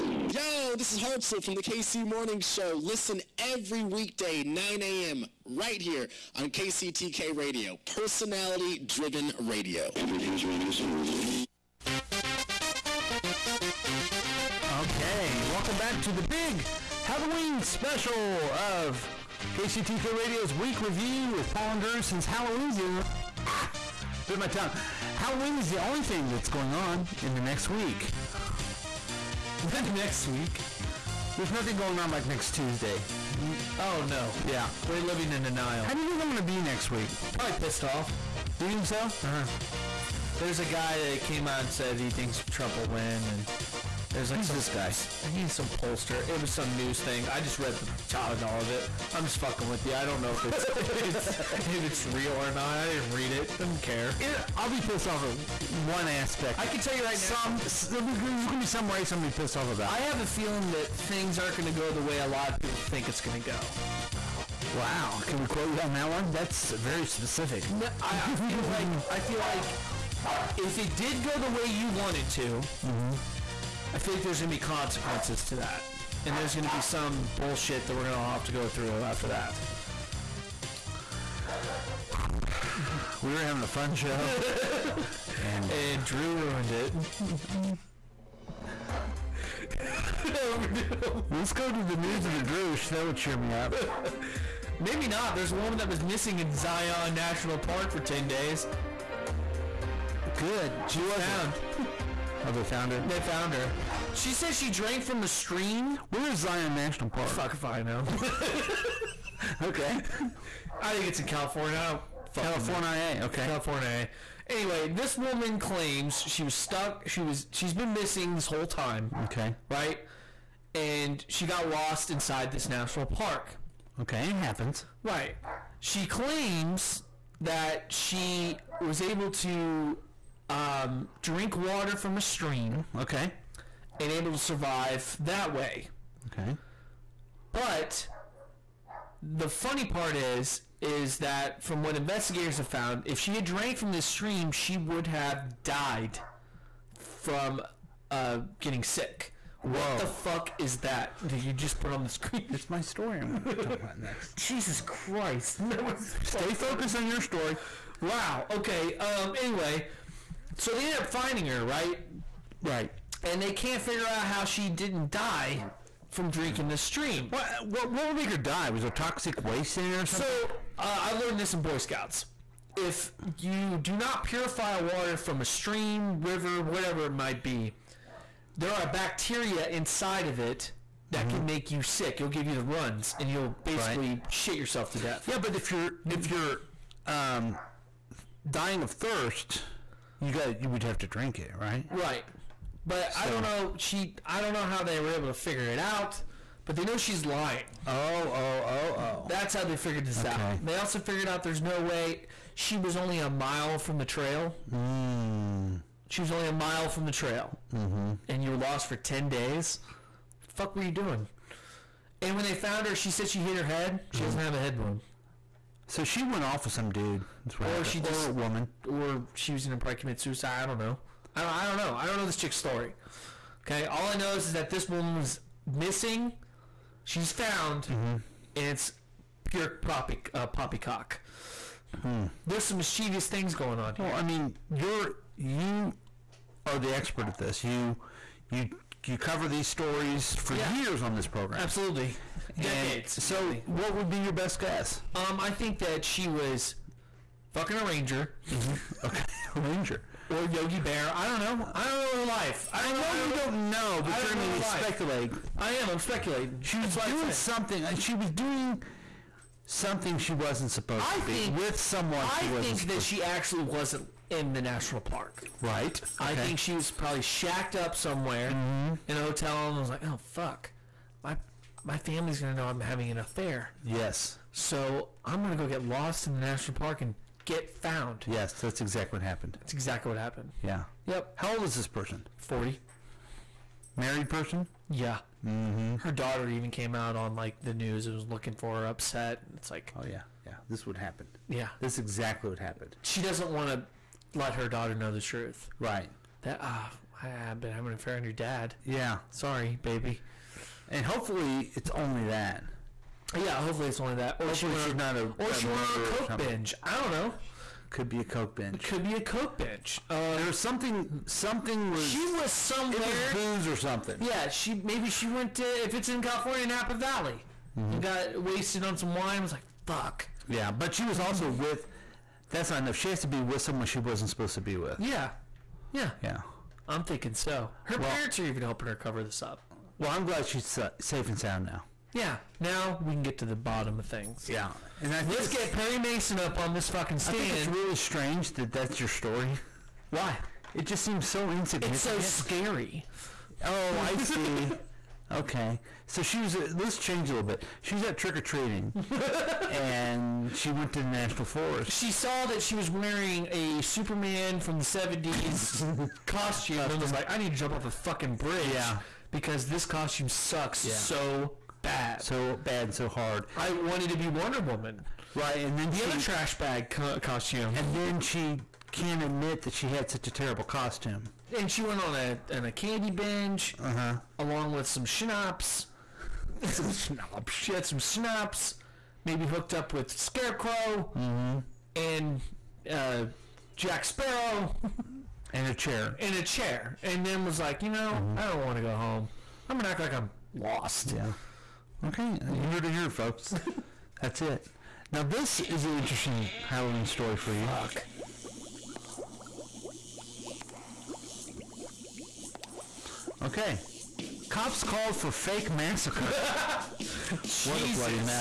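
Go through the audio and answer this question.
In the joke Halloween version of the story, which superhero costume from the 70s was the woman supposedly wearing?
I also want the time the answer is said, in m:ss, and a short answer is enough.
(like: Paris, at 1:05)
Superman, at 5:53.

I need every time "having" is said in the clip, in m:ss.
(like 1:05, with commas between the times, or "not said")
1:23, 4:32, 4:57.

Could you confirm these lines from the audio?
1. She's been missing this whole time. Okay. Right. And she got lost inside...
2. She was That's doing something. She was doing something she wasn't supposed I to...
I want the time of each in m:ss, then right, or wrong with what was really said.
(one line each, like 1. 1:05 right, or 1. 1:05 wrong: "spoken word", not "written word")
1. 1:57 right
2. 4:16 right.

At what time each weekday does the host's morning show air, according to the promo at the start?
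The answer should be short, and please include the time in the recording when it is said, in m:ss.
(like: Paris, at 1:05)
9 a.m., at 0:04.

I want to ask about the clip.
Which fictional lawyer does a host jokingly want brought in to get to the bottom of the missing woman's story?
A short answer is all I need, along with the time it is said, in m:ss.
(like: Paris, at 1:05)
Perry Mason, at 5:35.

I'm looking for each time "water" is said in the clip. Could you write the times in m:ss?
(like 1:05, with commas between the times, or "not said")
2:11, 2:54.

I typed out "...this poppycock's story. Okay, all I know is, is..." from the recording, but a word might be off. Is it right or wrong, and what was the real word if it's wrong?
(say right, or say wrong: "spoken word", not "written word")
wrong: "chick", not "poppycock".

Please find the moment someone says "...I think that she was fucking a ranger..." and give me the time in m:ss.
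4:05.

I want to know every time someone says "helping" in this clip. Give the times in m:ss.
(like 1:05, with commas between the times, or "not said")
5:28.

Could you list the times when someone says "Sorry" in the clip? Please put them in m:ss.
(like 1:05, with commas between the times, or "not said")
4:59.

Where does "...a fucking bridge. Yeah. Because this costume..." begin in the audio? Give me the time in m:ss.
5:57.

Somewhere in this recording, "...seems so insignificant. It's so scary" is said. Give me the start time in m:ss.
5:41.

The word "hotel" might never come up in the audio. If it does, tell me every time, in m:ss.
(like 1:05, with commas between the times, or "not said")
4:29.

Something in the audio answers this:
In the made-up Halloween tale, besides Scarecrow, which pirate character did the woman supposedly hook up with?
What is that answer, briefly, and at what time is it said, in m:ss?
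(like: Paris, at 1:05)
Jack Sparrow, at 6:23.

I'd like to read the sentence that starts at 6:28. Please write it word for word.
I don't want to go home.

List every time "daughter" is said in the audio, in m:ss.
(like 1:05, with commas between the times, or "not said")
4:46, 4:54.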